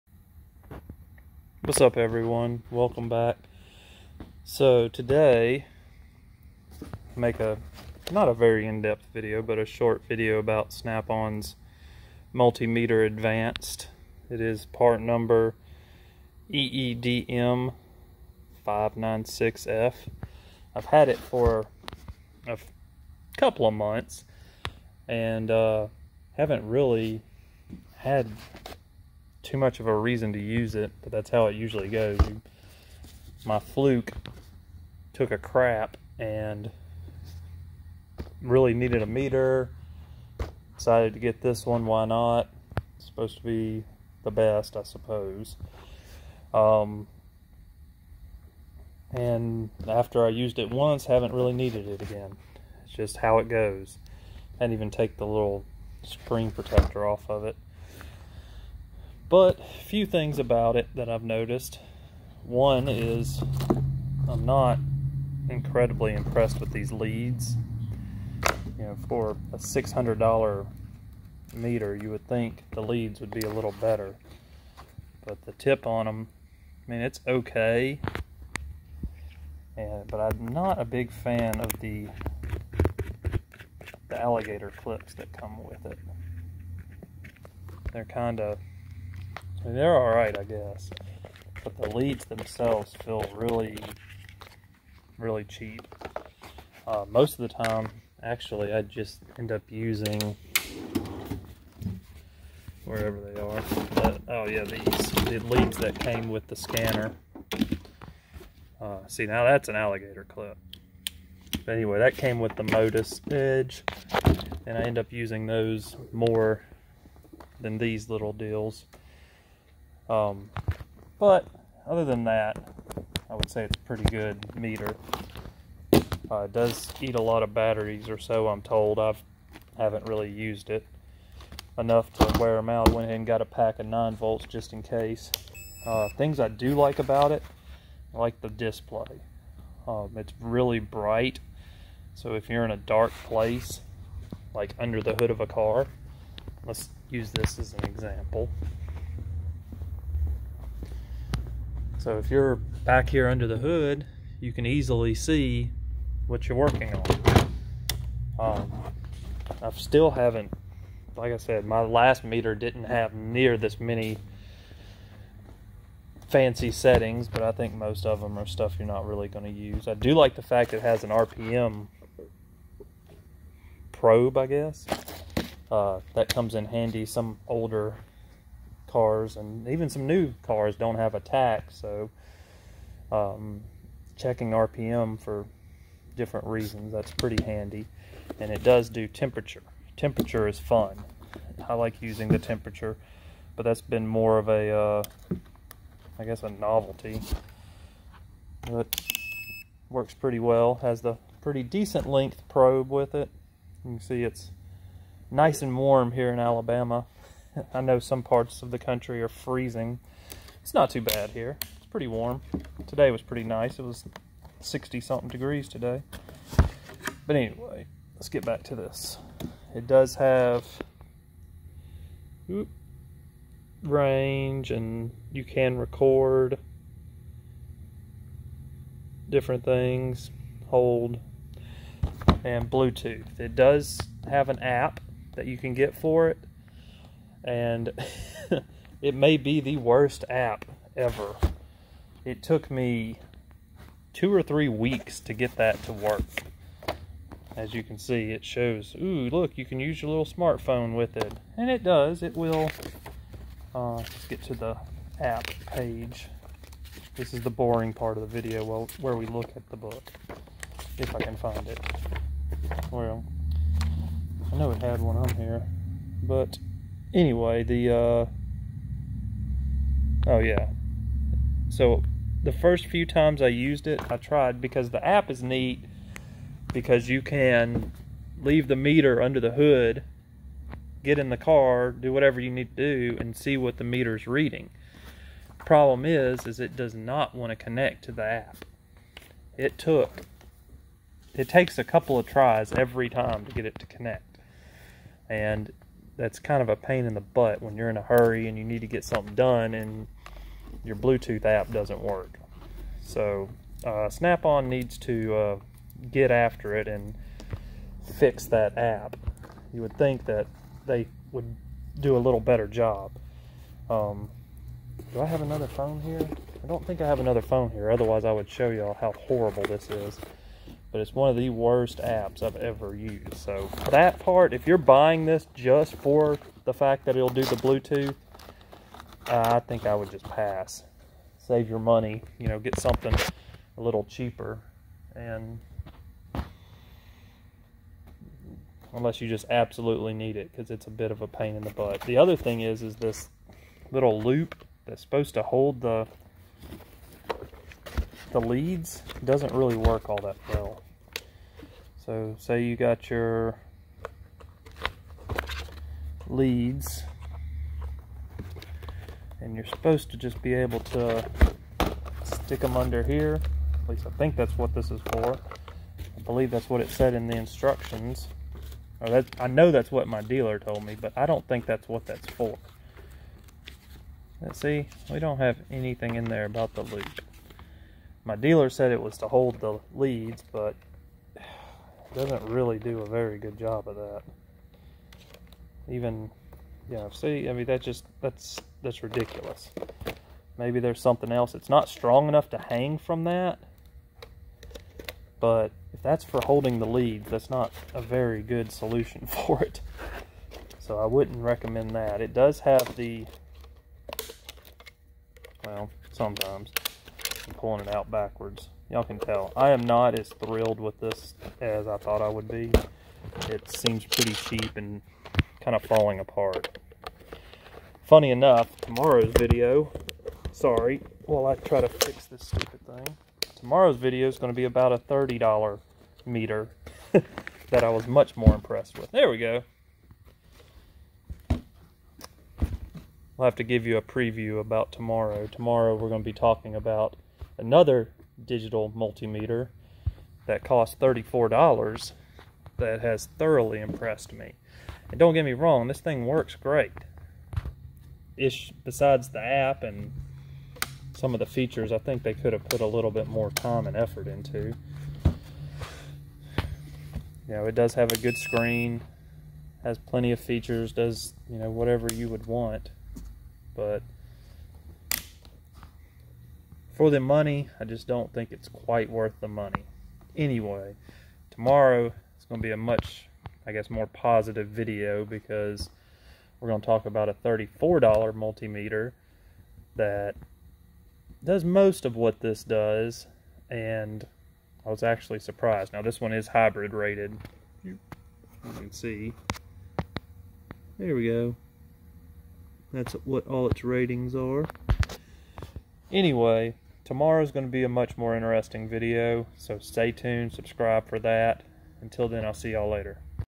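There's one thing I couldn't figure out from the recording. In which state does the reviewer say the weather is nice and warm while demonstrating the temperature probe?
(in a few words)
Alabama.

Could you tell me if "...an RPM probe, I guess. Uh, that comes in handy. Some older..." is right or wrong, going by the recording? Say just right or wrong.
right.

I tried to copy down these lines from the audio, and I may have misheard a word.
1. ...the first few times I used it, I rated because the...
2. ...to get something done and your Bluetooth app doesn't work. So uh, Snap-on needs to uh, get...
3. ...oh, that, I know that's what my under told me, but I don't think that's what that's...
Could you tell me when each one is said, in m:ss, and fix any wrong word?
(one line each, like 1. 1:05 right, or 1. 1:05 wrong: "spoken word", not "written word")
1. 4:32 wrong: "tried", not "rated"
2. 4:58 right
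3. 6:09 wrong: "dealer", not "under".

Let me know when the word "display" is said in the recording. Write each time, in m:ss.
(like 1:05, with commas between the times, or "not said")
2:18.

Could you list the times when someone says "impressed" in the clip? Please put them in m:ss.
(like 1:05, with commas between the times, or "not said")
1:06, 7:08, 7:23.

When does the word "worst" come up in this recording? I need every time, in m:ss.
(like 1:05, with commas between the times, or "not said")
3:59, 5:21.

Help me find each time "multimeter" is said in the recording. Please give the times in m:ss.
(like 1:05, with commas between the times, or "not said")
0:12, 7:18, 7:58.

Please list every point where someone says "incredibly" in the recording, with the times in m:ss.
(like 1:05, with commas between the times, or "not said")
1:05.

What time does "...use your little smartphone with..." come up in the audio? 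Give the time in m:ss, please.
4:09.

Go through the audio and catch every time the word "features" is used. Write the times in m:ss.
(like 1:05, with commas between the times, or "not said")
7:31, 7:40.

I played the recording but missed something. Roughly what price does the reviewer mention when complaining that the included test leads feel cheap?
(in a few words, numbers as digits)
$600.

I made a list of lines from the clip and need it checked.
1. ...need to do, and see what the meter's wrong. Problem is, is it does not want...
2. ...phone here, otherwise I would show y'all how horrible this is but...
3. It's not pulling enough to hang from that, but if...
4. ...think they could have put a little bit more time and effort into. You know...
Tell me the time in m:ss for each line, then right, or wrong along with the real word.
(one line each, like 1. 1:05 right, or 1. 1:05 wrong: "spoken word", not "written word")
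1. 4:42 wrong: "reading", not "wrong"
2. 5:17 right
3. 6:31 wrong: "strong", not "pulling"
4. 7:31 right.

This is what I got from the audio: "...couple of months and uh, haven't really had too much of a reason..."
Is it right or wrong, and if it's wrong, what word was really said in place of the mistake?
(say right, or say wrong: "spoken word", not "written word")
right.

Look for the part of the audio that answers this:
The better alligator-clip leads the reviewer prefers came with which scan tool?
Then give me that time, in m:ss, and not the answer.
1:52.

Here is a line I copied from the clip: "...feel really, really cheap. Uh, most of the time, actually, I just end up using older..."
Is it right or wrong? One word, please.
wrong.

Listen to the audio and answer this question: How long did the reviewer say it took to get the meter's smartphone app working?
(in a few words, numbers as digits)
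Two or three weeks.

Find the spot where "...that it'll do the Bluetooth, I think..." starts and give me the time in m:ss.
5:27.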